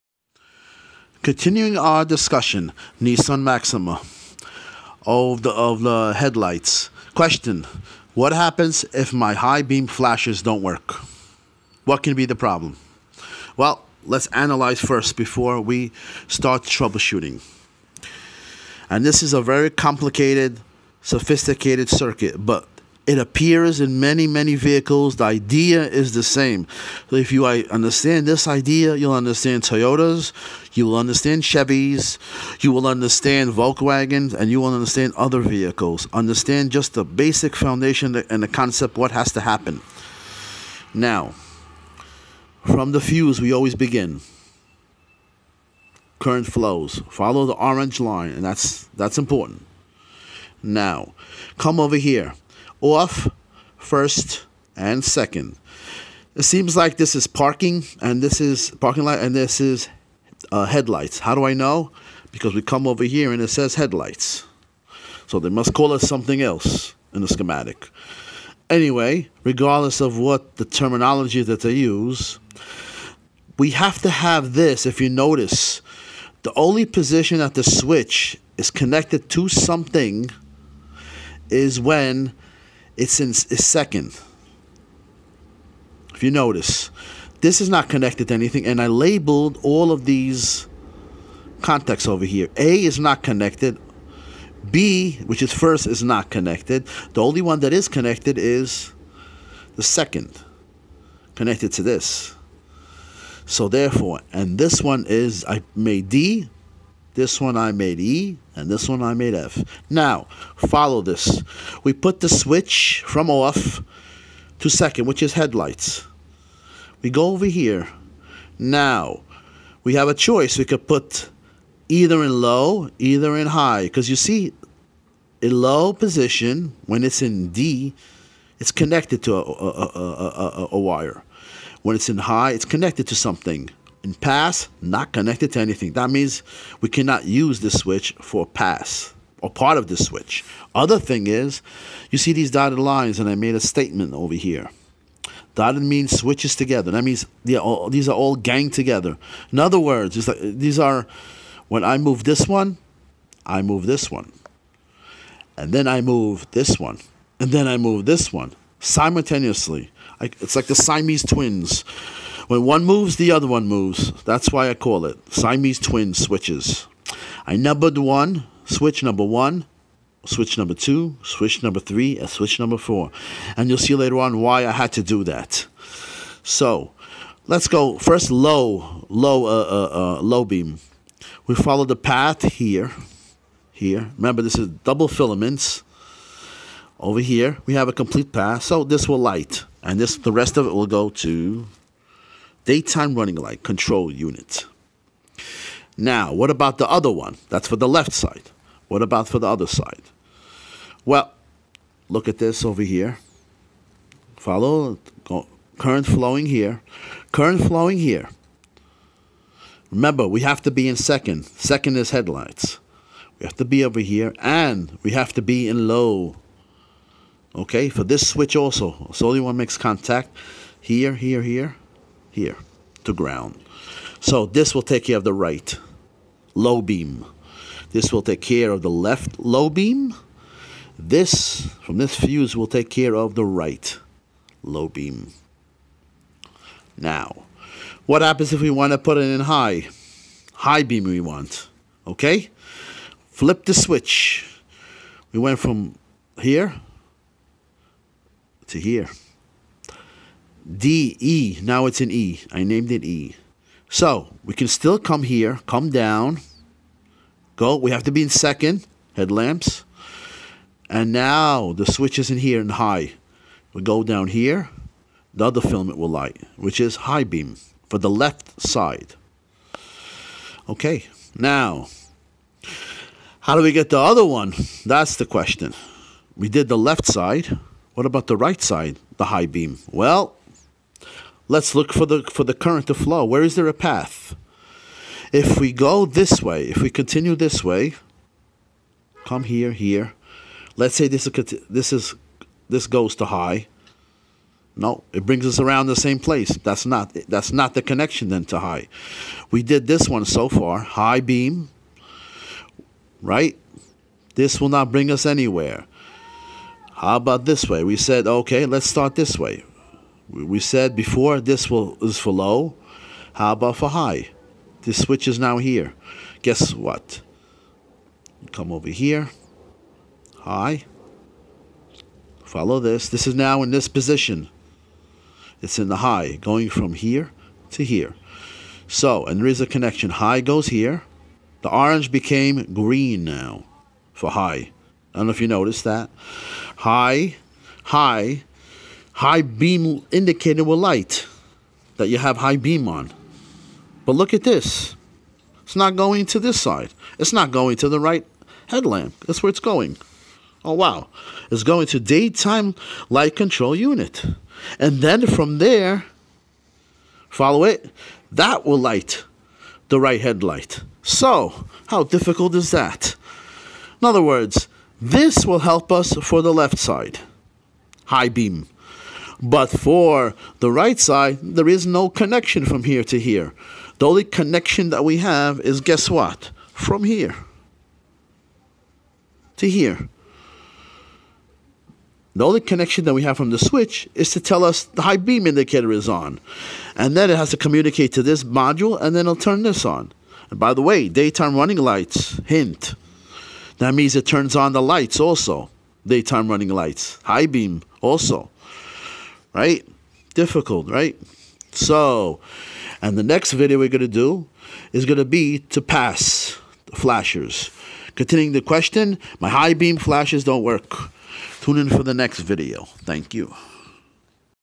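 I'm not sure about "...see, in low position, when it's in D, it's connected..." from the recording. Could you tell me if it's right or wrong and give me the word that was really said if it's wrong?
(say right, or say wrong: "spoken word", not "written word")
right.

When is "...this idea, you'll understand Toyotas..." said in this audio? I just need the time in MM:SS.
00:28.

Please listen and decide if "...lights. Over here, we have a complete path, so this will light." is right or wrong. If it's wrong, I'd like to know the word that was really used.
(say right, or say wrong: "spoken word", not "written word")
wrong: "filaments", not "lights".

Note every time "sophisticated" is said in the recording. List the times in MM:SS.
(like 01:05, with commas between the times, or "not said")
00:21.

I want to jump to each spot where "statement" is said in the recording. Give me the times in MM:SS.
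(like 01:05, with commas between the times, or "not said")
02:23.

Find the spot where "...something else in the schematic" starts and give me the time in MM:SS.
01:06.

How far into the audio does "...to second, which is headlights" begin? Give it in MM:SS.
01:54.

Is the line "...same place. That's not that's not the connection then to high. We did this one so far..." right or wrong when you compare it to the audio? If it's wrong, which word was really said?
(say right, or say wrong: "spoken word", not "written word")
right.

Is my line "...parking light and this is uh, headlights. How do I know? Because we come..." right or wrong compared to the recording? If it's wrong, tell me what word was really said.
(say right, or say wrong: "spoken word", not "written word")
right.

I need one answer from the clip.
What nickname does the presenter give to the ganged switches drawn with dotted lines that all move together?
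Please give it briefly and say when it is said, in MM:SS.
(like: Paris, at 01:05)
Siamese twin switches, at 02:45.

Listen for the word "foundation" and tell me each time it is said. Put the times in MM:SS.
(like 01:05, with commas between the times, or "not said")
00:37.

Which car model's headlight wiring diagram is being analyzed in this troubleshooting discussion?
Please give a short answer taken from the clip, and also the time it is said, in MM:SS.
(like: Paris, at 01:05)
Nissan Maxima, at 00:02.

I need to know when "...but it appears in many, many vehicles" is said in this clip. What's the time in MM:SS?
00:22.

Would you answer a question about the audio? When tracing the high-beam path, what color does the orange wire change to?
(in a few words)
Green.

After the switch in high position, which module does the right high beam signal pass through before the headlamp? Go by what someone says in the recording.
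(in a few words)
Daytime running light control unit.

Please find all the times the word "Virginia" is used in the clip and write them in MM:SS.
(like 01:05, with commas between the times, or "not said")
not said.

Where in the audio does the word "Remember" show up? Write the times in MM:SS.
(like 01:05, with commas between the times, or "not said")
03:04, 03:29.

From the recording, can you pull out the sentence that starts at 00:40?
Now, from the fuse, we always begin.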